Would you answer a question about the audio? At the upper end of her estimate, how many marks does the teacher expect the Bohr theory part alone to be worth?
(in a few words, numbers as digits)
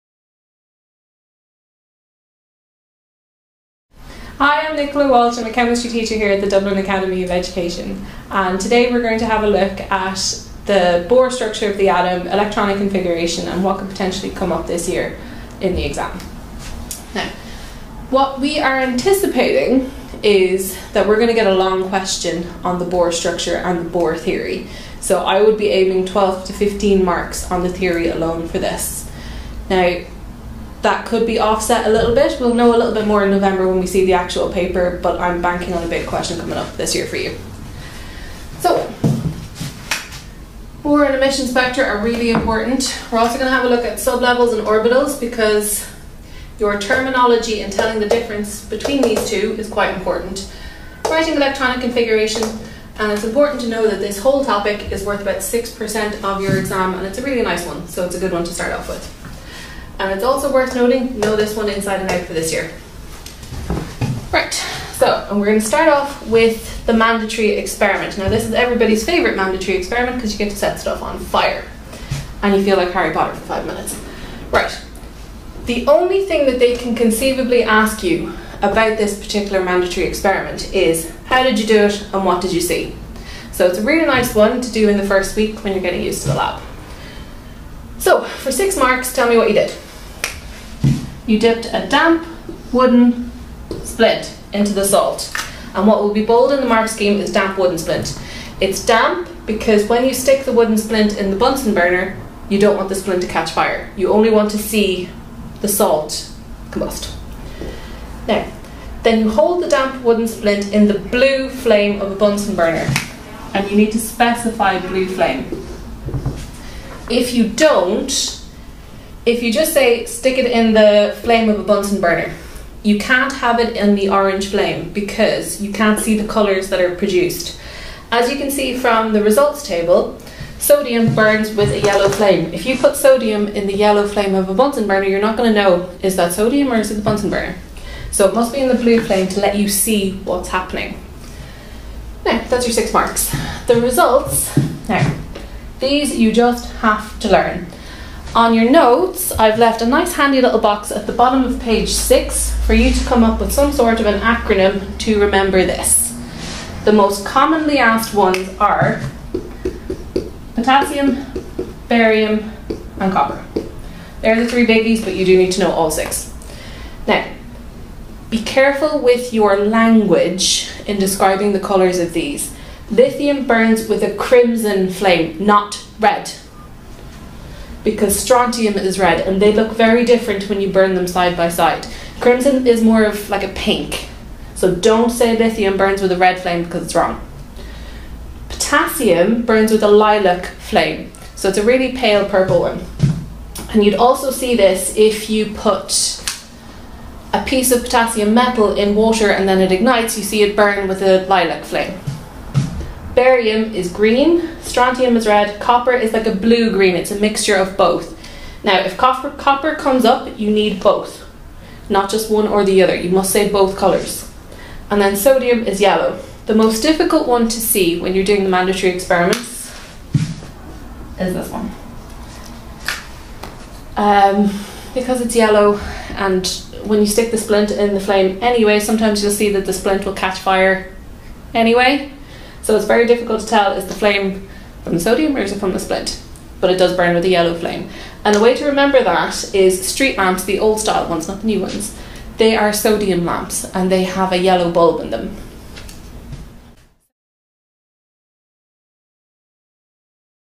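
15.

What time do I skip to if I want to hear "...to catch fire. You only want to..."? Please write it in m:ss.
1:43.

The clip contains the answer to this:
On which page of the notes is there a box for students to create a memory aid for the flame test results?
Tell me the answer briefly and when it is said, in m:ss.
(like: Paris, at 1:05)
page 6, at 2:31.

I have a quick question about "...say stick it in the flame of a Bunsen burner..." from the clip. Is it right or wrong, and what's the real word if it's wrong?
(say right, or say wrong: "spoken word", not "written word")
right.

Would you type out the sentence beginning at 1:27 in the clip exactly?
So, for six marks, tell me what you did you dipped a damp wooden splint into the salt.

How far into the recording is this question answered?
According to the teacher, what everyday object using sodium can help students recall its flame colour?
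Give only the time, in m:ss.
3:59.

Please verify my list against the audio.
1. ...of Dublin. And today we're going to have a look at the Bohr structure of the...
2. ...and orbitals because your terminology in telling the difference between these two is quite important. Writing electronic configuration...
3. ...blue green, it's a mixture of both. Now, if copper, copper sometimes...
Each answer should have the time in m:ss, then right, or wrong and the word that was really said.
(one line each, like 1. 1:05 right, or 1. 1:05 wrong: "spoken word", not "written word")
1. 0:07 wrong: "Education", not "Dublin"
2. 0:44 right
3. 3:26 wrong: "comes", not "sometimes".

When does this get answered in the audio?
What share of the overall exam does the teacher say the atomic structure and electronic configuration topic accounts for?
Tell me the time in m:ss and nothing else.
0:55.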